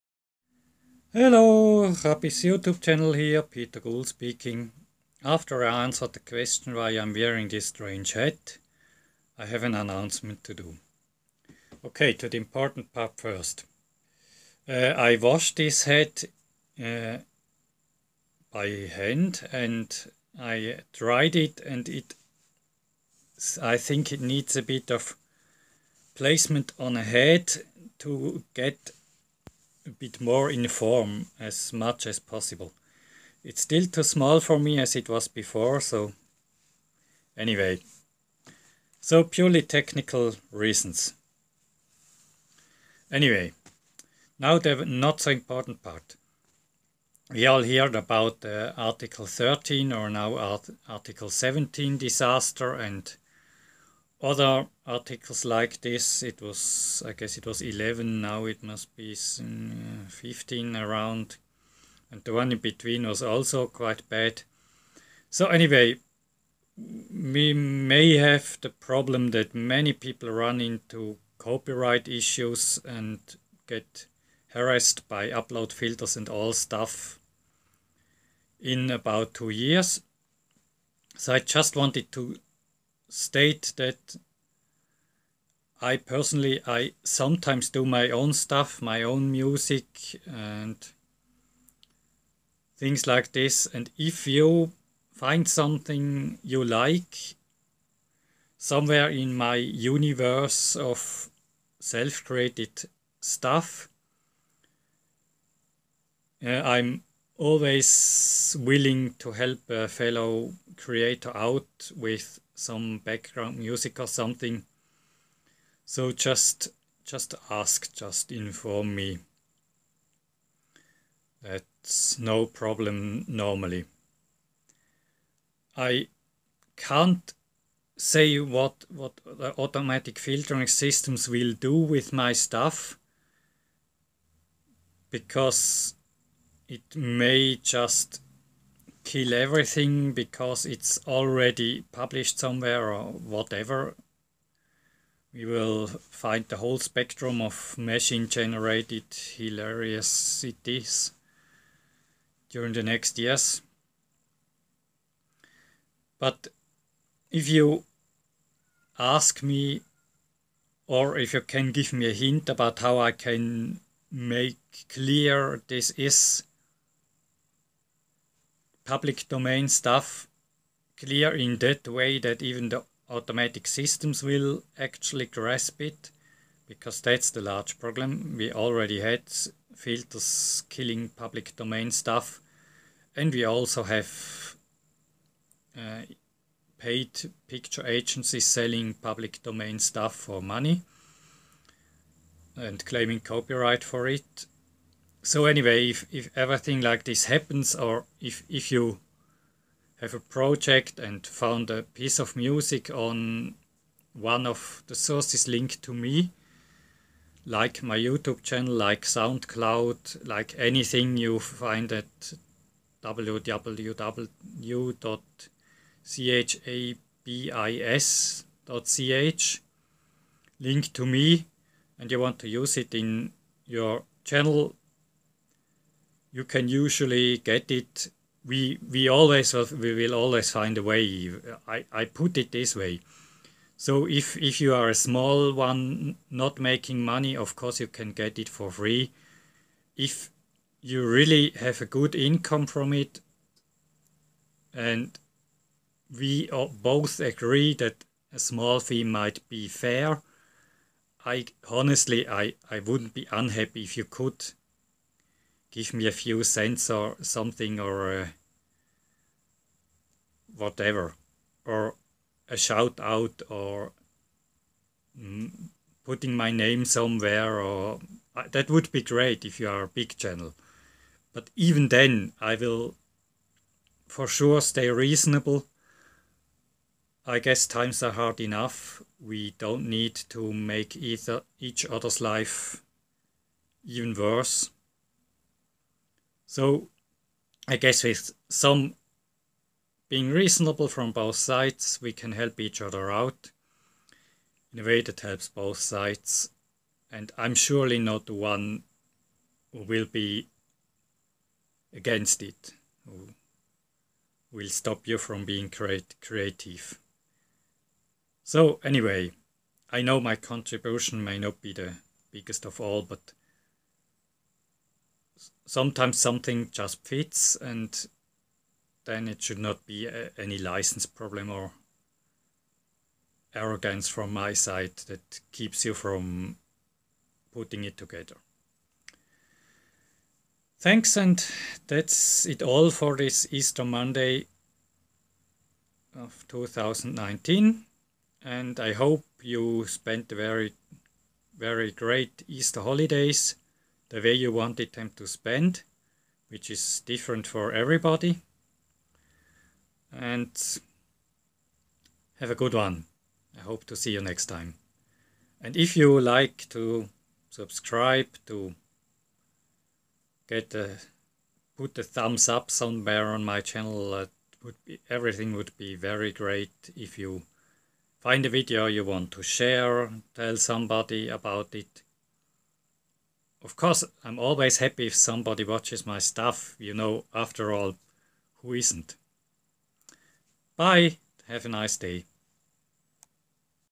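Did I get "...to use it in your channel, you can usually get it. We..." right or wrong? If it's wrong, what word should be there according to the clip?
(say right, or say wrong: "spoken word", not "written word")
right.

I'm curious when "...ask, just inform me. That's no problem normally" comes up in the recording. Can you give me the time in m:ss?
1:57.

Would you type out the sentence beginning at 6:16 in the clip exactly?
You know, after all, who isn't?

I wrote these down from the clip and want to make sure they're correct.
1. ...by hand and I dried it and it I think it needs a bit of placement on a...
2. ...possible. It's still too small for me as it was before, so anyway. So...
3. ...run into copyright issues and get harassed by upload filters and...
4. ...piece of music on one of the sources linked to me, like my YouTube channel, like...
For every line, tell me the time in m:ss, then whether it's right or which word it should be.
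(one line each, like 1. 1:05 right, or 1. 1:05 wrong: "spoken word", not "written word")
1. 0:18 right
2. 0:32 right
3. 1:10 right
4. 3:21 right.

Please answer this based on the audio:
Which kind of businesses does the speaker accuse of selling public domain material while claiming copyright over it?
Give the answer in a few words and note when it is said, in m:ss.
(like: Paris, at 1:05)
paid picture agencies, at 3:06.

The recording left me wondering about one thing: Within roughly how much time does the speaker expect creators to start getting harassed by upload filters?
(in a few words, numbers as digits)
two years.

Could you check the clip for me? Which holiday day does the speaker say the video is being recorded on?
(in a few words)
Easter Monday.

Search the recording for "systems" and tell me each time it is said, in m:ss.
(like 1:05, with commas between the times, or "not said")
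2:10, 2:53.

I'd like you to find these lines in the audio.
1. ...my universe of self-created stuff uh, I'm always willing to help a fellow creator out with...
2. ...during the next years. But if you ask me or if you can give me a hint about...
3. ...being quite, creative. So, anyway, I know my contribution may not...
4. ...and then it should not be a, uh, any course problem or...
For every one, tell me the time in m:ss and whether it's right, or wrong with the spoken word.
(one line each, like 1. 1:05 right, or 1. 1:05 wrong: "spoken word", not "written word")
1. 1:39 right
2. 2:32 right
3. 5:05 wrong: "create", not "quite"
4. 5:17 wrong: "license", not "course".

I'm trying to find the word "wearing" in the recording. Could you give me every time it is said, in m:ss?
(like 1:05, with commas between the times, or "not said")
0:07.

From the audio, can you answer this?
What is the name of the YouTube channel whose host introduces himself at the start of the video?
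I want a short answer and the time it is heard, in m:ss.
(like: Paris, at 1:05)
Chabis, at 0:01.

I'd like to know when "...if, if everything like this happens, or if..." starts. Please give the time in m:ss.
3:15.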